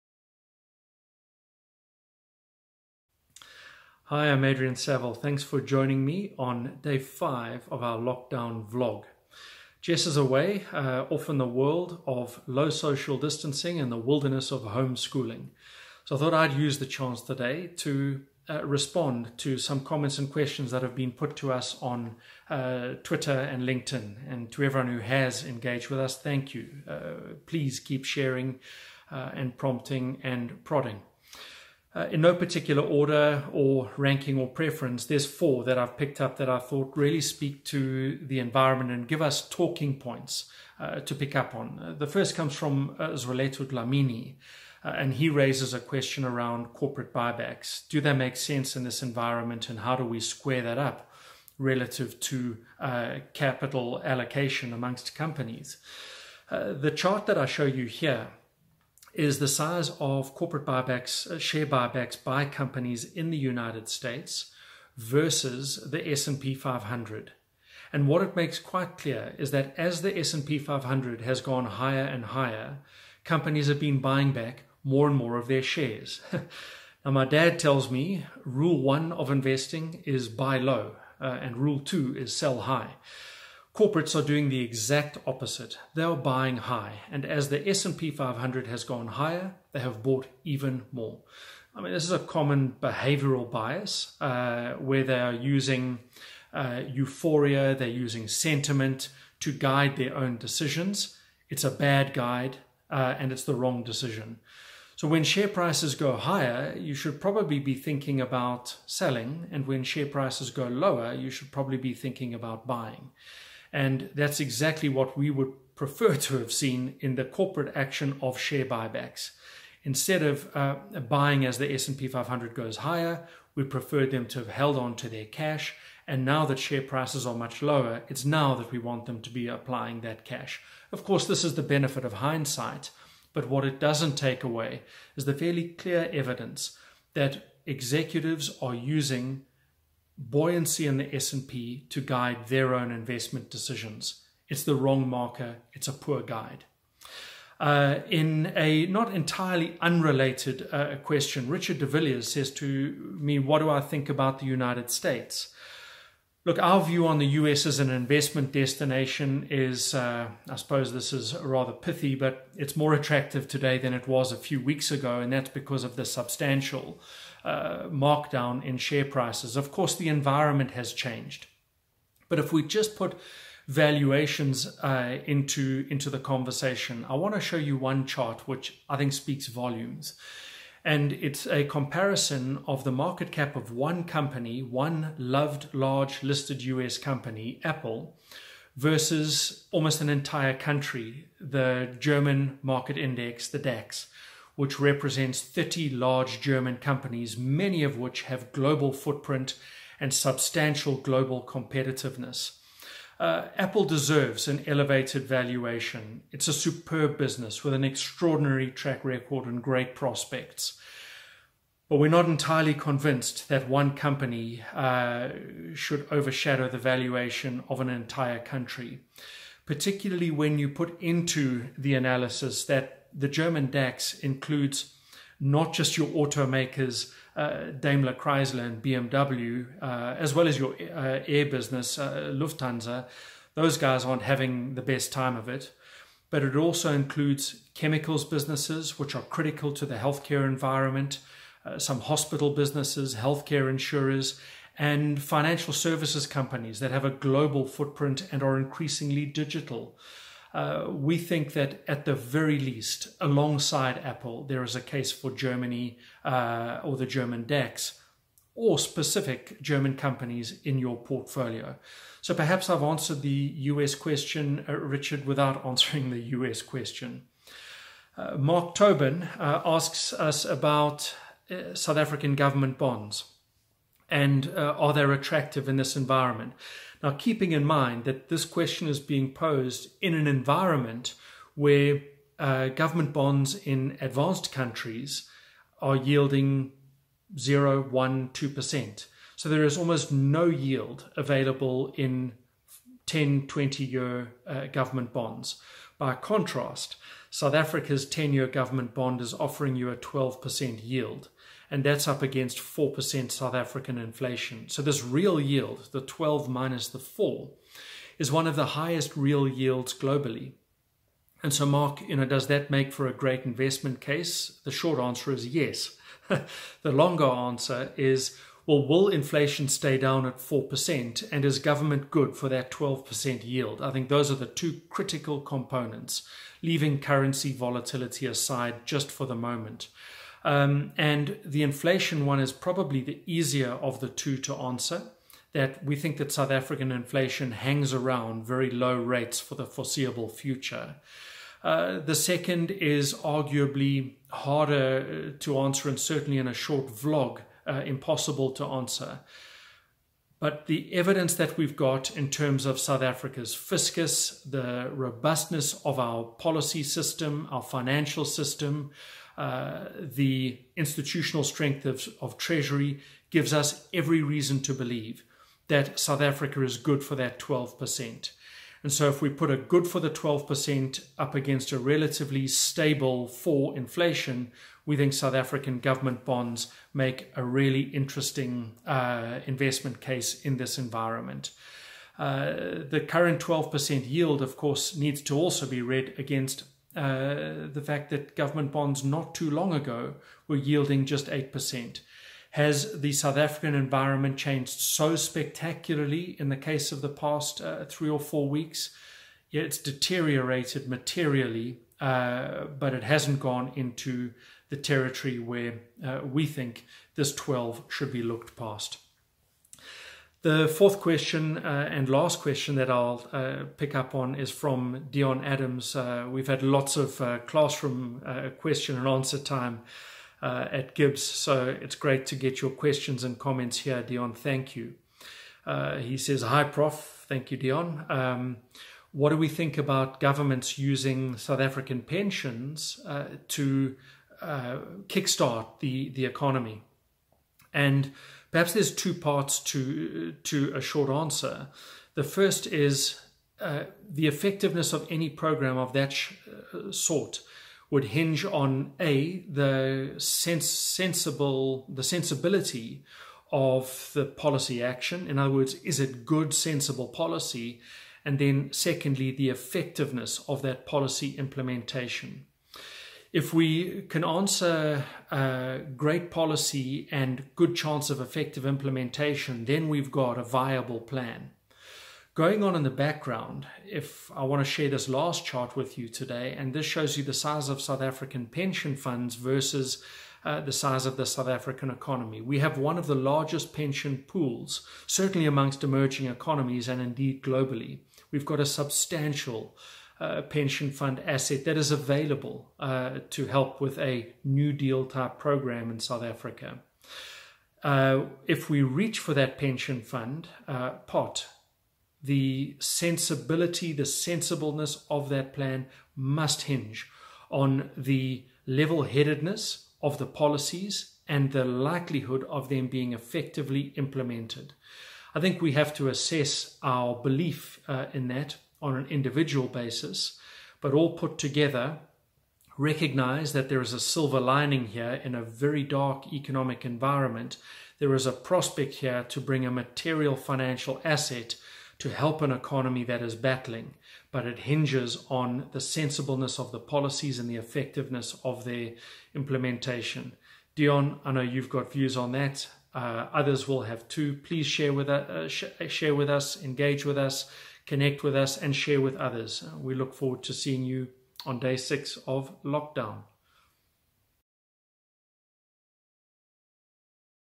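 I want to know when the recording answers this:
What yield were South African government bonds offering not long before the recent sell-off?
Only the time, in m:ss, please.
6:31.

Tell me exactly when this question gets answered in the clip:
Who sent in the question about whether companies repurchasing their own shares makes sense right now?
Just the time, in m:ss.
0:43.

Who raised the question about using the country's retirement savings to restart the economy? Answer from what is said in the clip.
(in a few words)
Dion Adams.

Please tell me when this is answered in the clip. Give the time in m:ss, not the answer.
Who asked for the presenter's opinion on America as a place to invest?
2:31.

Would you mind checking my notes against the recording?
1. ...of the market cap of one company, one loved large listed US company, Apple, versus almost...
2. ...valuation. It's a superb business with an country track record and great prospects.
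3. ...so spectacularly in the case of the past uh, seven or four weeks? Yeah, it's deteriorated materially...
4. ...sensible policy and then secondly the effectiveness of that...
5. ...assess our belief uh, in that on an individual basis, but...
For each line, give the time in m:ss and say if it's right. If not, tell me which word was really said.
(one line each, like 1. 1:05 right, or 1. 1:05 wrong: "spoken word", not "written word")
1. 3:02 right
2. 3:25 wrong: "extraordinary", not "country"
3. 6:34 wrong: "three", not "seven"
4. 7:36 right
5. 8:36 right.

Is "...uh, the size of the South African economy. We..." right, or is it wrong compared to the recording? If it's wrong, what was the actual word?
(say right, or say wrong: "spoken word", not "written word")
right.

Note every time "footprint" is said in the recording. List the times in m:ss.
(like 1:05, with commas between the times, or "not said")
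3:18, 4:07.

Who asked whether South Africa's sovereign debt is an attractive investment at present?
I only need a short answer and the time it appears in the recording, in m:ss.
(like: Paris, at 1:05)
Mark Tobin, at 4:28.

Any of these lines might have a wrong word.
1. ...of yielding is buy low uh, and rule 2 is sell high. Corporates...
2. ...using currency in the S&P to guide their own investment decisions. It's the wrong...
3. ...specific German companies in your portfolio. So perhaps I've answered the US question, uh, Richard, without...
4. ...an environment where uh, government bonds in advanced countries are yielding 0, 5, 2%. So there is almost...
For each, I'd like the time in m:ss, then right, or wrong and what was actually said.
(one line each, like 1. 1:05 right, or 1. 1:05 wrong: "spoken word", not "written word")
1. 1:19 wrong: "investing", not "yielding"
2. 2:18 wrong: "buoyancy", not "currency"
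3. 4:18 right
4. 4:40 wrong: "1", not "5".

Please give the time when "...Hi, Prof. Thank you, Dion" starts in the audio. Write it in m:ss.
7:06.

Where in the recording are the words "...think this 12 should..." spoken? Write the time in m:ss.
6:46.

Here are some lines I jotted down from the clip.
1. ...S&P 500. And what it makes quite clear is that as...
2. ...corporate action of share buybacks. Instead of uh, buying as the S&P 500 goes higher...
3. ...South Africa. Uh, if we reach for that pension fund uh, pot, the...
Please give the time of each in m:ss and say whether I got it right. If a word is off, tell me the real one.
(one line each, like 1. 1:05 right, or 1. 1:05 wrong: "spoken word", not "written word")
1. 1:06 right
2. 1:57 right
3. 8:15 right.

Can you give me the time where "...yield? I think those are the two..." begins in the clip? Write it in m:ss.
5:23.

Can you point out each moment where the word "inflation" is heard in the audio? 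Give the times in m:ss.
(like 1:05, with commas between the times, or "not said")
5:03, 5:19, 5:31, 5:36, 6:13.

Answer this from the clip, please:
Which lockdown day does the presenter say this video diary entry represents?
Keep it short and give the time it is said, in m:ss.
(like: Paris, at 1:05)
Day 5, at 0:06.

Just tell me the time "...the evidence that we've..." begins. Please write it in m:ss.
5:50.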